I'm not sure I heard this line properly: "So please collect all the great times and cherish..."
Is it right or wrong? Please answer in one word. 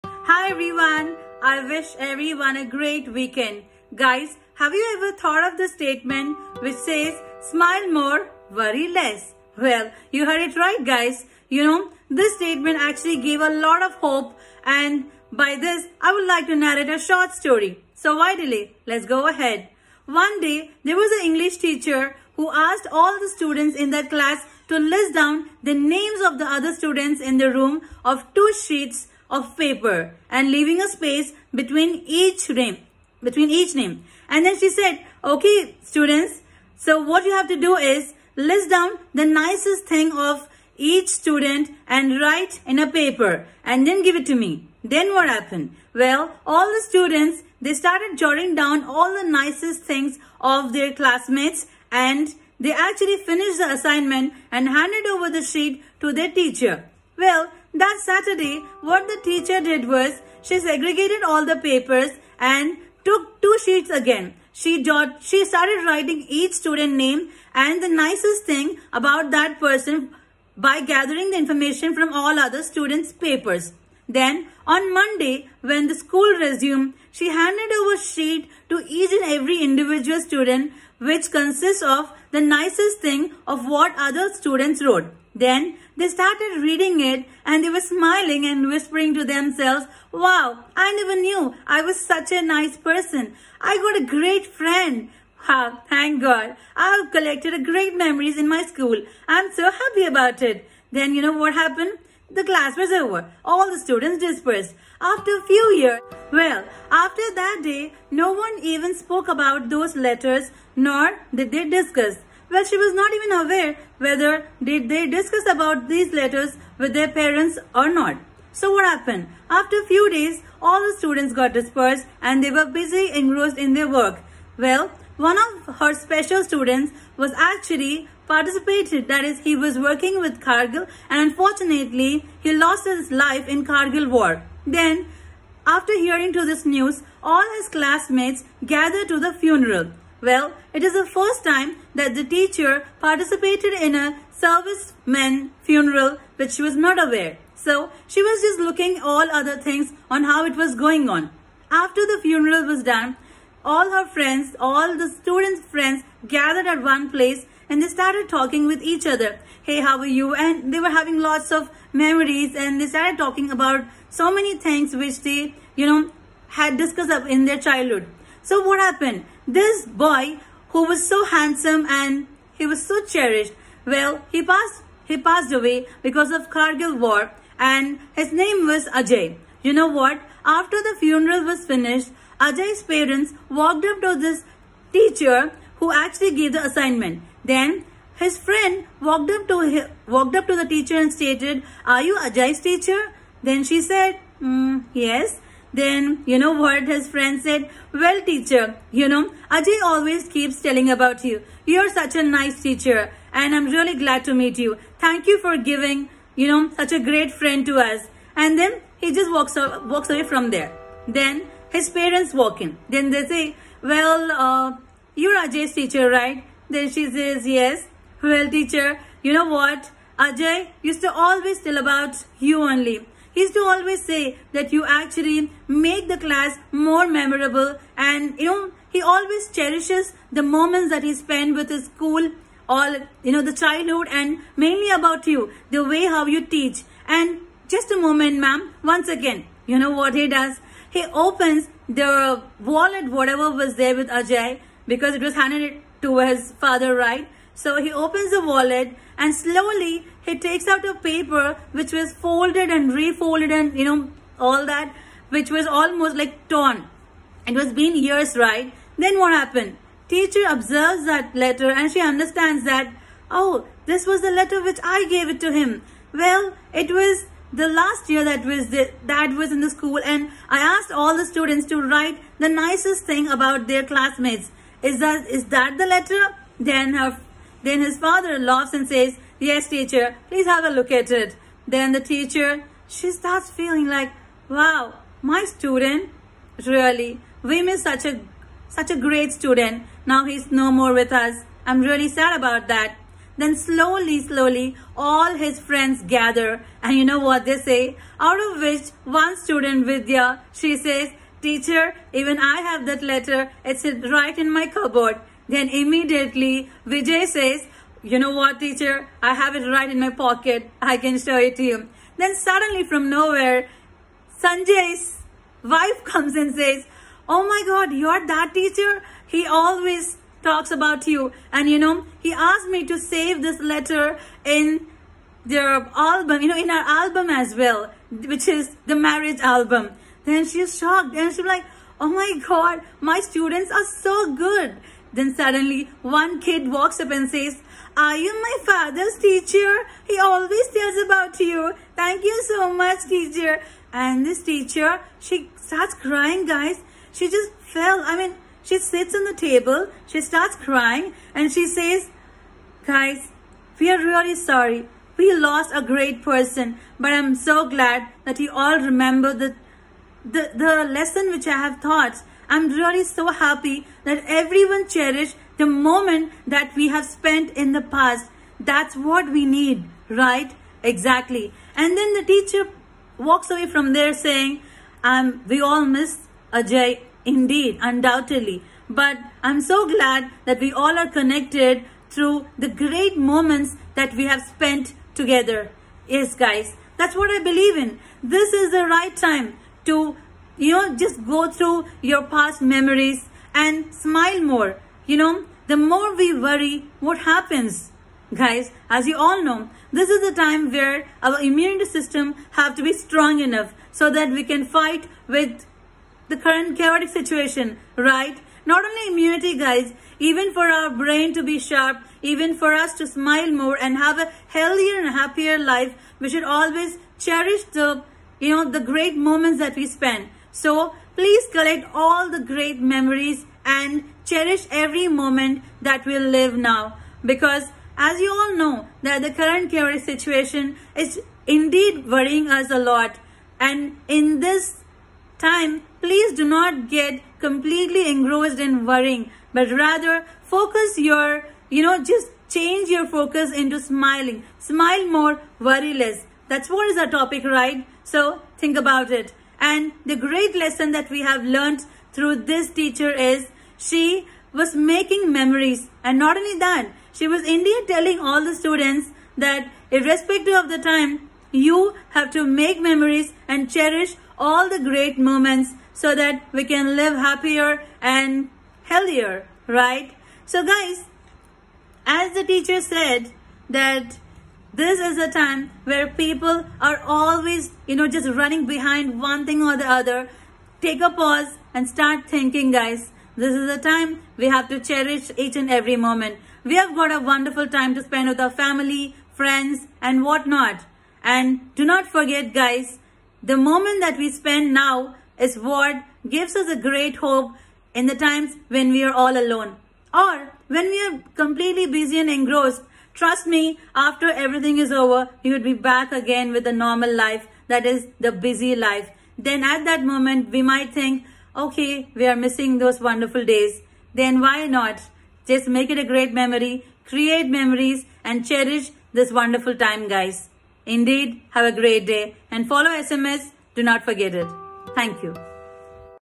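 wrong.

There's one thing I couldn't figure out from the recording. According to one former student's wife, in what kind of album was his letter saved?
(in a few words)
marriage album.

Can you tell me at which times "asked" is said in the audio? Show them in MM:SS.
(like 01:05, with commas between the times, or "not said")
00:22, 04:30, 05:22.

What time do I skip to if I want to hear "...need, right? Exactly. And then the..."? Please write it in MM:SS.
06:09.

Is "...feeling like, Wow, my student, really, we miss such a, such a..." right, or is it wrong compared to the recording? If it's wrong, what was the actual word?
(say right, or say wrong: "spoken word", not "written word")
right.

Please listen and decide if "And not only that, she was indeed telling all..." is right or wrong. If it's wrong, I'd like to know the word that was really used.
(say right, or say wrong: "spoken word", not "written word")
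right.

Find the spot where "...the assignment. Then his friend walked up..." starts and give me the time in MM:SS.
03:06.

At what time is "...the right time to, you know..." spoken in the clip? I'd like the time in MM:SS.
06:28.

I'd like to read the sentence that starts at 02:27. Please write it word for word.
So, she was just looking all other things on how it was going on.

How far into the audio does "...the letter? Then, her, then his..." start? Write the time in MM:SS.
04:35.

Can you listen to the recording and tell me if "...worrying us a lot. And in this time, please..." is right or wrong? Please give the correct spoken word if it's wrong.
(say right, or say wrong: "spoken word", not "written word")
right.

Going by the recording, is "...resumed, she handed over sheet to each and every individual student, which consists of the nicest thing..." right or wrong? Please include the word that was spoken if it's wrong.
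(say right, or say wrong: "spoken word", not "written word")
right.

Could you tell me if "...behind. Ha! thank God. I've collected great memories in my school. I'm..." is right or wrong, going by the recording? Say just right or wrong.
wrong.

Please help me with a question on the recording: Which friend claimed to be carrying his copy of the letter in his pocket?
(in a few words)
Vijay.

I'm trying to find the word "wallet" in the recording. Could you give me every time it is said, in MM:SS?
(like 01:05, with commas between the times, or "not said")
04:02, 04:08.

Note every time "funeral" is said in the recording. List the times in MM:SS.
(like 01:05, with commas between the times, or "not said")
02:19, 02:25, 02:32, 03:00.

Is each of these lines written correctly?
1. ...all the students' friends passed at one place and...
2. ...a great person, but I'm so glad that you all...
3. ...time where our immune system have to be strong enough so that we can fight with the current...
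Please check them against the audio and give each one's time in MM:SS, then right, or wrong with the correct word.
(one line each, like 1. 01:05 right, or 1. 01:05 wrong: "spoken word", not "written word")
1. 02:34 wrong: "gathered", not "passed"
2. 05:55 right
3. 06:40 right.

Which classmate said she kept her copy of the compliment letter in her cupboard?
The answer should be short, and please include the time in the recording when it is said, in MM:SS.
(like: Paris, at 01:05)
Vidya, at 04:59.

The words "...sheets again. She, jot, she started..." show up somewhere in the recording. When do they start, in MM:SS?
01:03.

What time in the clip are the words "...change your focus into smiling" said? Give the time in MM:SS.
07:22.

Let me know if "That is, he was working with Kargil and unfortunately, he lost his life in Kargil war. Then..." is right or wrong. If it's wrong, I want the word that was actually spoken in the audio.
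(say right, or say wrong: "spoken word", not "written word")
right.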